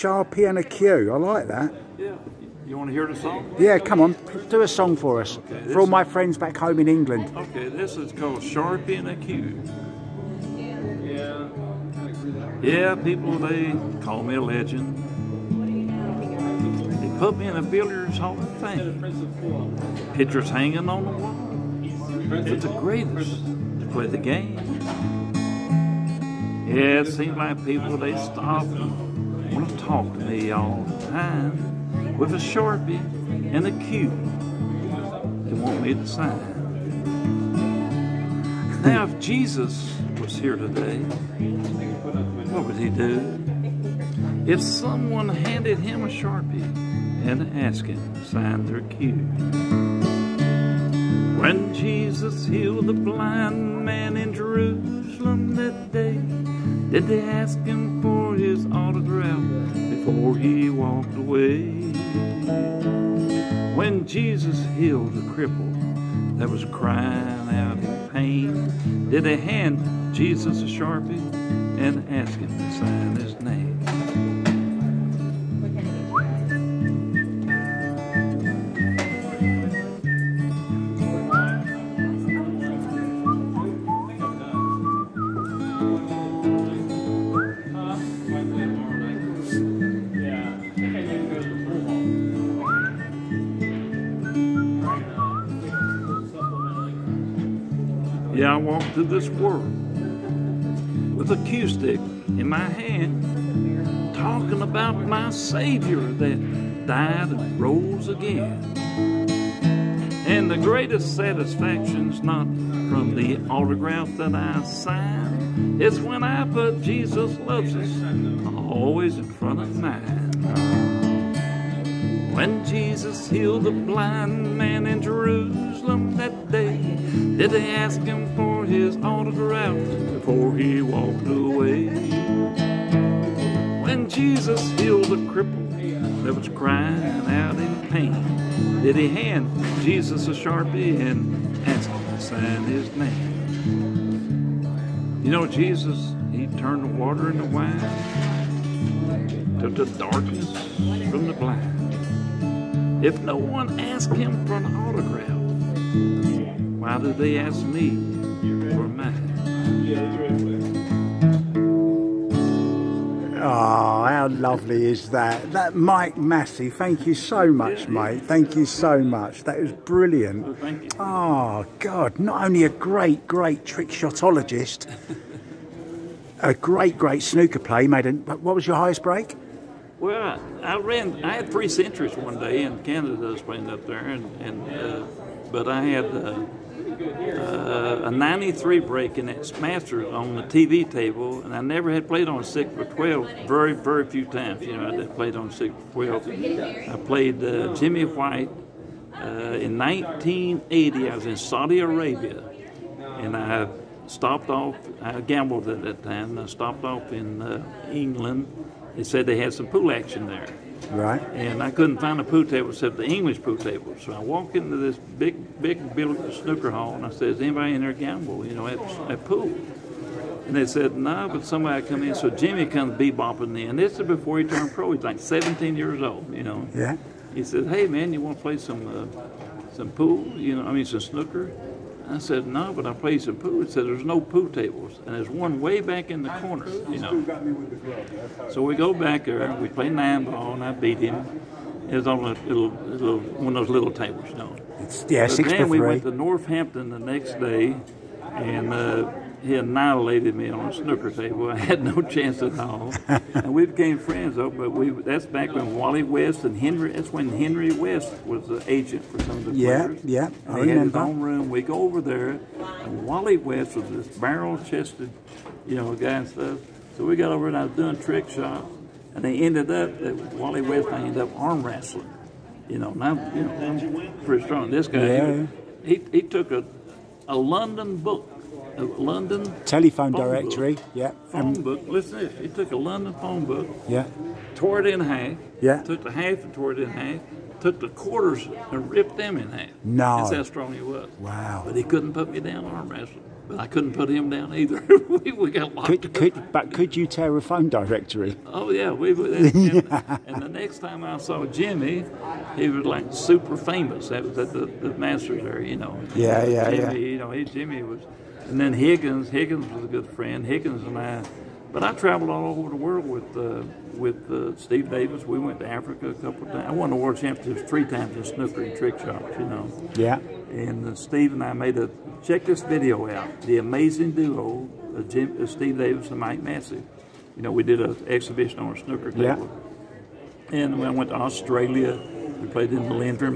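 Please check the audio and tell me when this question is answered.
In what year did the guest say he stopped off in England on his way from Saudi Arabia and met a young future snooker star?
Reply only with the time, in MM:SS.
03:19.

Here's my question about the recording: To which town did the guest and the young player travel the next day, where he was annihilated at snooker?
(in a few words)
Northampton.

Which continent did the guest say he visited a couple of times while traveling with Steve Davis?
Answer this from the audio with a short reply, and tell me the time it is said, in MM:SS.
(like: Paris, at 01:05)
Africa, at 05:15.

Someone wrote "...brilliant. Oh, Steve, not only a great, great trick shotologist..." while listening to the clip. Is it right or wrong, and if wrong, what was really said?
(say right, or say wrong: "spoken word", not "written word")
wrong: "God", not "Steve".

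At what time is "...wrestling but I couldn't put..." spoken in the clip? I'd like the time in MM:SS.
04:52.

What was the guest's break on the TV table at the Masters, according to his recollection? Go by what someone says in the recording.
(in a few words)
93.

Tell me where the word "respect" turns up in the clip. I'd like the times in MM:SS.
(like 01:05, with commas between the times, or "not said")
not said.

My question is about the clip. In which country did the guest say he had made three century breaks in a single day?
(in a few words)
Canada.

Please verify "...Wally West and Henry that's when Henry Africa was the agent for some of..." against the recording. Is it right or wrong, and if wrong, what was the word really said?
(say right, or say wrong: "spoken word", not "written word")
wrong: "West", not "Africa".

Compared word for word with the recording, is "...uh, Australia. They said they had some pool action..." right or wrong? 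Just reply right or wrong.
wrong.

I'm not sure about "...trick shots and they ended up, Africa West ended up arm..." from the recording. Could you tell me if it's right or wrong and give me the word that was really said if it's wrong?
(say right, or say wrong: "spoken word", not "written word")
wrong: "Wally", not "Africa".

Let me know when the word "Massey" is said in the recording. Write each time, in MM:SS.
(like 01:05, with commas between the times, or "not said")
02:46, 05:26.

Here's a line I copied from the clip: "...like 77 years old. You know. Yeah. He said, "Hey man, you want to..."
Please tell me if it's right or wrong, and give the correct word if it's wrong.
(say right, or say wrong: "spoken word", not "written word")
wrong: "17", not "77".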